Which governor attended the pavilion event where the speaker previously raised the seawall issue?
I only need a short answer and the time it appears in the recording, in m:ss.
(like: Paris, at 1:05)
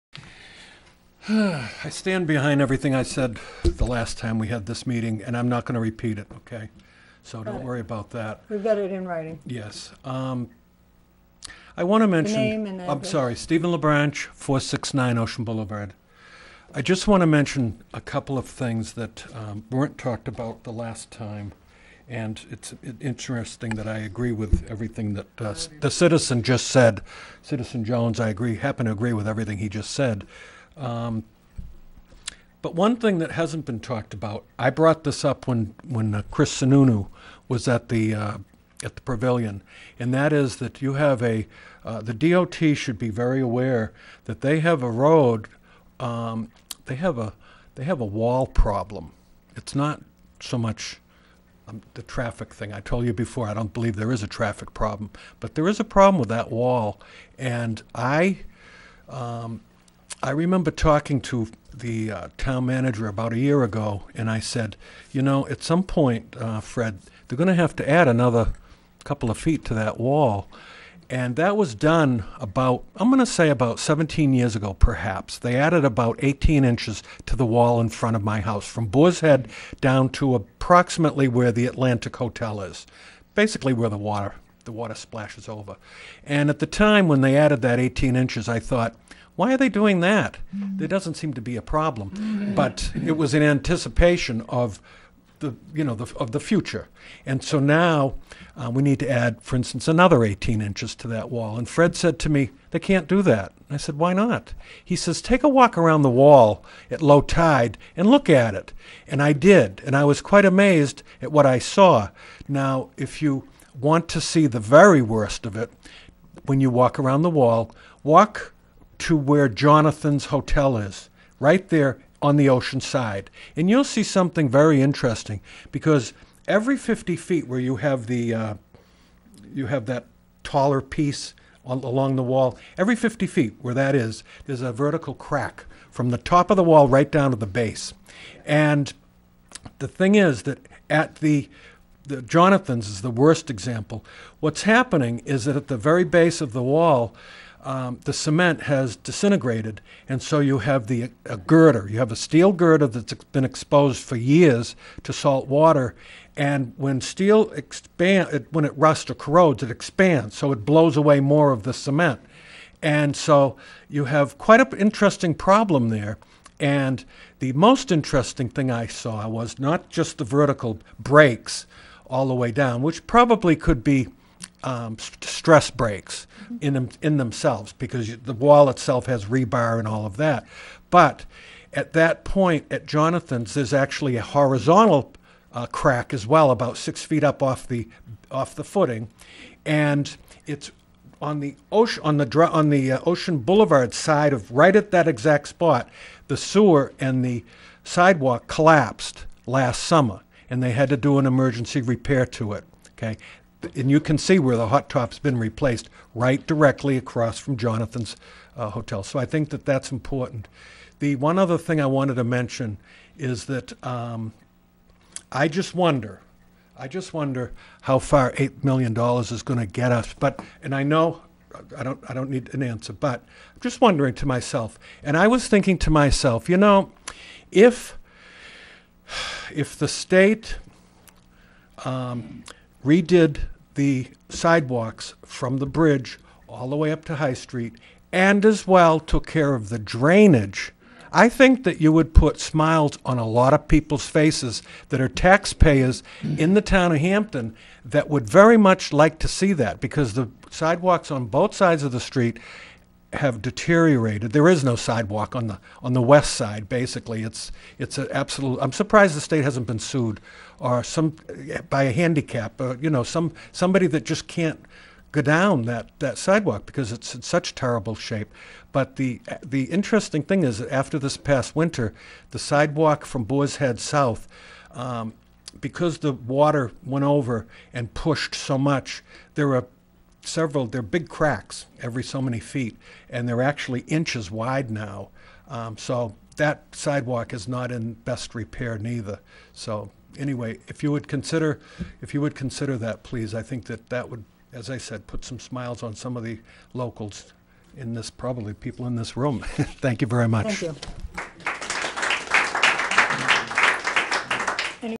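Chris Sununu, at 0:36.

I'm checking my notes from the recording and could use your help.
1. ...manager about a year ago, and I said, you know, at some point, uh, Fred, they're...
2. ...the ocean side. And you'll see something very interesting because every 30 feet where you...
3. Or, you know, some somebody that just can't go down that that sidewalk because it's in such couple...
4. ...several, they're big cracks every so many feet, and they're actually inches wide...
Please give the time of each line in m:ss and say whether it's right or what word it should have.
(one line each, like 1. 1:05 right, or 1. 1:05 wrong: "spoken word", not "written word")
1. 1:02 right
2. 2:02 wrong: "50", not "30"
3. 4:22 wrong: "terrible", not "couple"
4. 4:40 right.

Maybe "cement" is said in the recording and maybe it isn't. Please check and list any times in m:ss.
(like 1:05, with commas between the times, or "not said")
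2:28, 2:41.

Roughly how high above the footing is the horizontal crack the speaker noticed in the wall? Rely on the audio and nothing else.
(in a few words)
6 feet.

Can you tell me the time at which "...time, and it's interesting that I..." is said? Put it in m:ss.
0:21.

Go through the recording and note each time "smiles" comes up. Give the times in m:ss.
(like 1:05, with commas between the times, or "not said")
4:02, 4:55.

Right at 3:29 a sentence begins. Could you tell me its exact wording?
So I think that that's important.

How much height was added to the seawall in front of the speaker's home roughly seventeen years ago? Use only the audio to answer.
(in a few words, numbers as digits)
18 inches.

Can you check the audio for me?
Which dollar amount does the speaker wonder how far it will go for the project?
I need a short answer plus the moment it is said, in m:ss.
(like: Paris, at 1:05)
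$8 million, at 3:38.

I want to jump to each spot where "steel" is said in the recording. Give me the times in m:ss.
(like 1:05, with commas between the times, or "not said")
2:32, 2:37.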